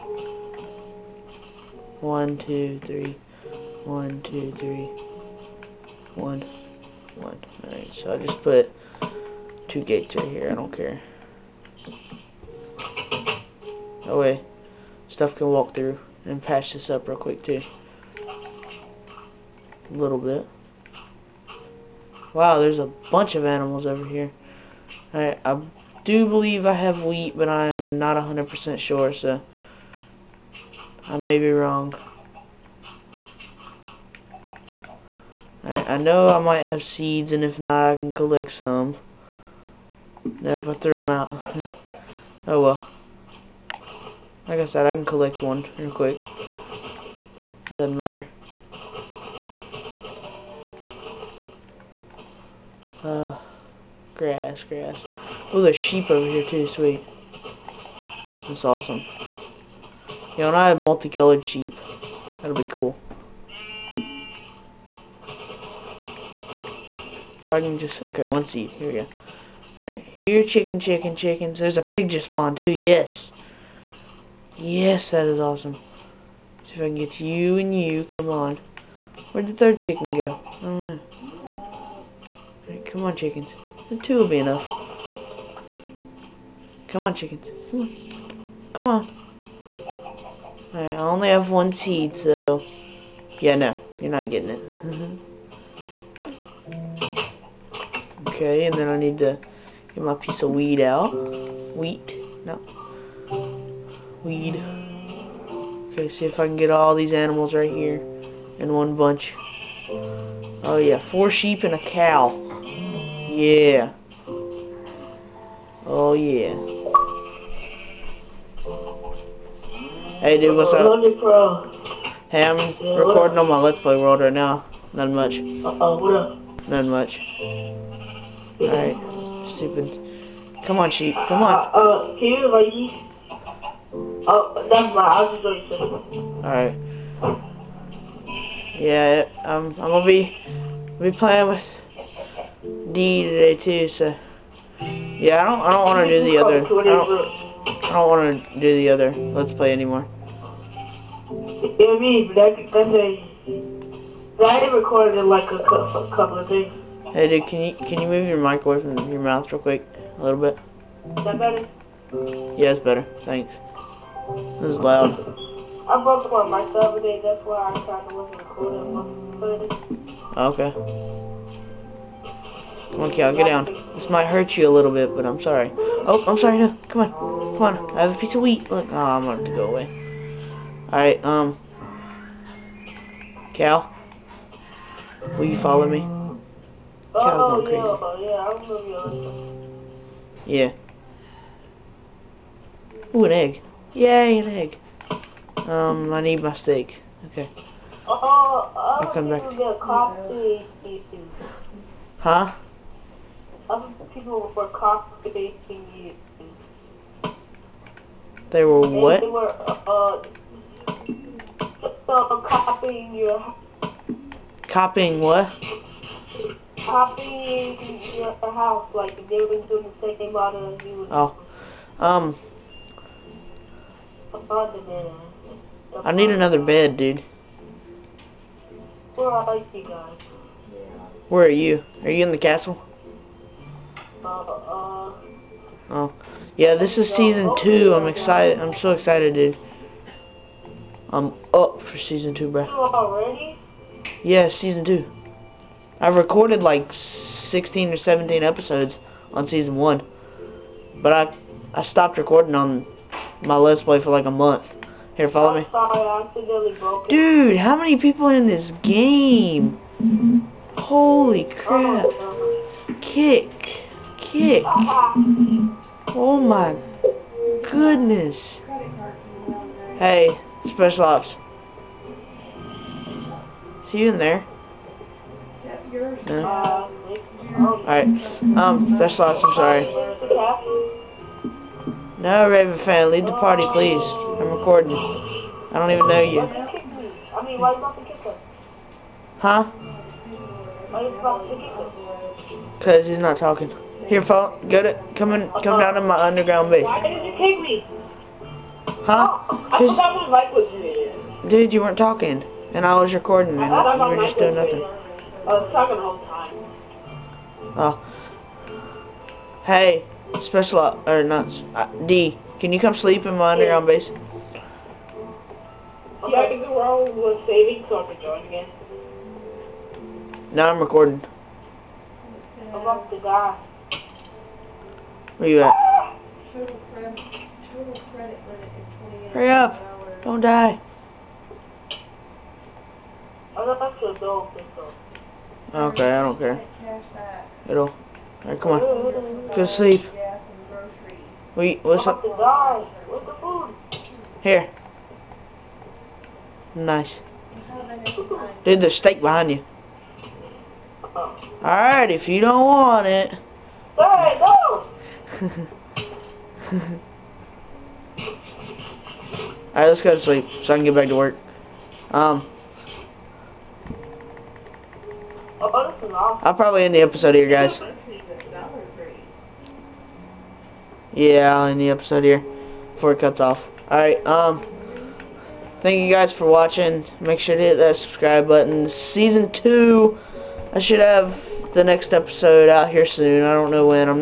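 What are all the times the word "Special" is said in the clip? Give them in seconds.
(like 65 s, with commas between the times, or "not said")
270 s, 278 s, 310 s.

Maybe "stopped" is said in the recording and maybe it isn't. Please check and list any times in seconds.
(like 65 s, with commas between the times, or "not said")
251 s.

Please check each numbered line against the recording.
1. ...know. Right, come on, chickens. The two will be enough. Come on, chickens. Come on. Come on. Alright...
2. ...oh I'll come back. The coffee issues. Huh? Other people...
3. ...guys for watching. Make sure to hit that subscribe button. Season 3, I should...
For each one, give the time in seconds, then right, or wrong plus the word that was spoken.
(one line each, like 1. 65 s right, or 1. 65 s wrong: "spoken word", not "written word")
1. 80 s right
2. 198 s right
3. 376 s wrong: "2", not "3".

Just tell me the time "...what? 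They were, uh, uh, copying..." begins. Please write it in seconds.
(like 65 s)
208 s.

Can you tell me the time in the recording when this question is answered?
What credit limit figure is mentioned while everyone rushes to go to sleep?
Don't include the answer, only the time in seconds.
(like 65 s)
329 s.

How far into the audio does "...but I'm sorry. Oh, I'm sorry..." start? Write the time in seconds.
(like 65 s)
175 s.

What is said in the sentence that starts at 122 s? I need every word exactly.
Hey, I'm recording on my Let's Play World right now.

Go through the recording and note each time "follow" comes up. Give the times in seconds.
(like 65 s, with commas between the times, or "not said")
185 s, 255 s.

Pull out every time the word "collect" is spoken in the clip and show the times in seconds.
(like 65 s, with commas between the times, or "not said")
38 s, 45 s.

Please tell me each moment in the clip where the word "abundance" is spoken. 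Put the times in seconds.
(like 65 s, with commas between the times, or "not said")
not said.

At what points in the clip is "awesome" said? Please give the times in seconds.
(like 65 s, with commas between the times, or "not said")
58 s, 75 s.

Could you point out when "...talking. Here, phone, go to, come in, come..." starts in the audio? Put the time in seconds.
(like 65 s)
293 s.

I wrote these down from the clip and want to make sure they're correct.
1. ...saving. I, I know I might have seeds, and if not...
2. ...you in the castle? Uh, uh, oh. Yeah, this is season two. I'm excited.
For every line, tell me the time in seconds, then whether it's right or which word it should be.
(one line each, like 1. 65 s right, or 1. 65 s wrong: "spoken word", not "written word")
1. 31 s wrong: "wrong", not "saving"
2. 232 s right.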